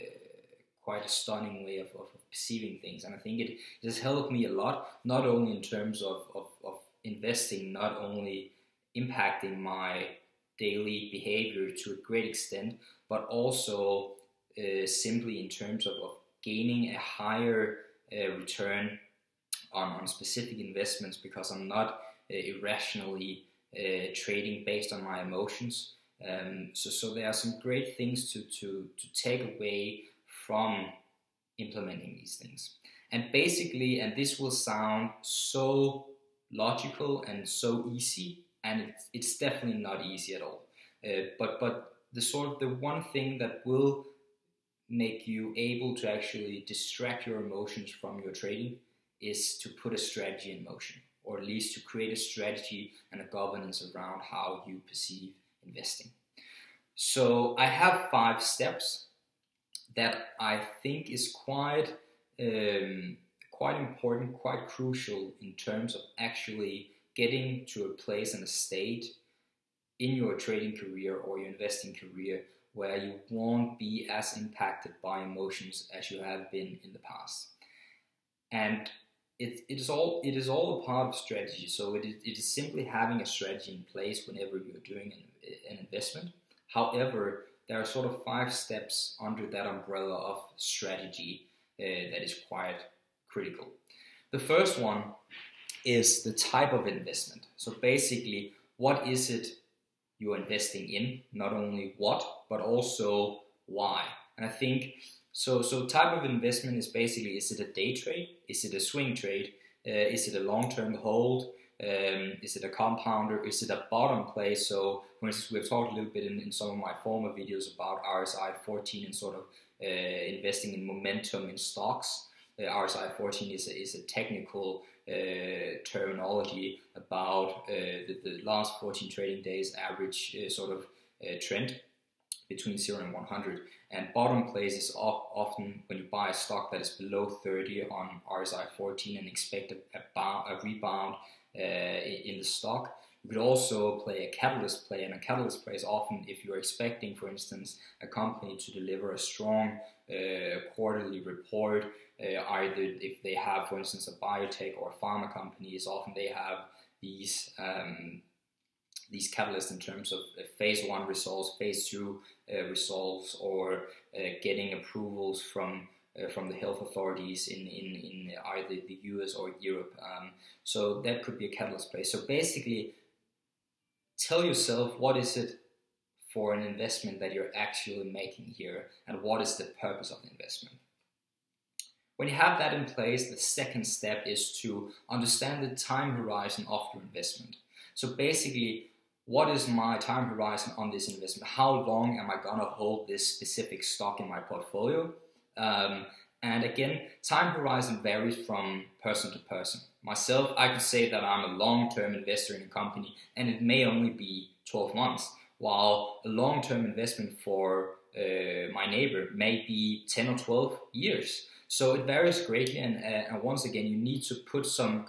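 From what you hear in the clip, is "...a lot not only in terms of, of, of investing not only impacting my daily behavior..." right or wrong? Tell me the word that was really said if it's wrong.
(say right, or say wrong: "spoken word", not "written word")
right.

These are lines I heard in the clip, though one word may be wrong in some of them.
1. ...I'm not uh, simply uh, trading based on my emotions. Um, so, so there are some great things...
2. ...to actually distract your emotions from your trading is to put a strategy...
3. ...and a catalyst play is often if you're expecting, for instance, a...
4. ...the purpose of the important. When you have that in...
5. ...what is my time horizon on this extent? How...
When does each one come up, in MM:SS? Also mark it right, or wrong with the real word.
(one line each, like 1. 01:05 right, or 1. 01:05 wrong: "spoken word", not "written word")
1. 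00:21 wrong: "irrationally", not "simply"
2. 00:45 right
3. 02:25 right
4. 02:59 wrong: "investment", not "important"
5. 03:09 wrong: "investment", not "extent".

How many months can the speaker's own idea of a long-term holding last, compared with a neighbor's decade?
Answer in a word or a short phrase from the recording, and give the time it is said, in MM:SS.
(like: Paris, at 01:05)
12 months, at 03:24.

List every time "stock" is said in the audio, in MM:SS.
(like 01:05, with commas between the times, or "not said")
02:01, 02:16, 02:22, 03:13.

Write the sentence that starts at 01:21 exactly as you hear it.
So it is, it is simply having a strategy in place whenever you're doing an, an investment.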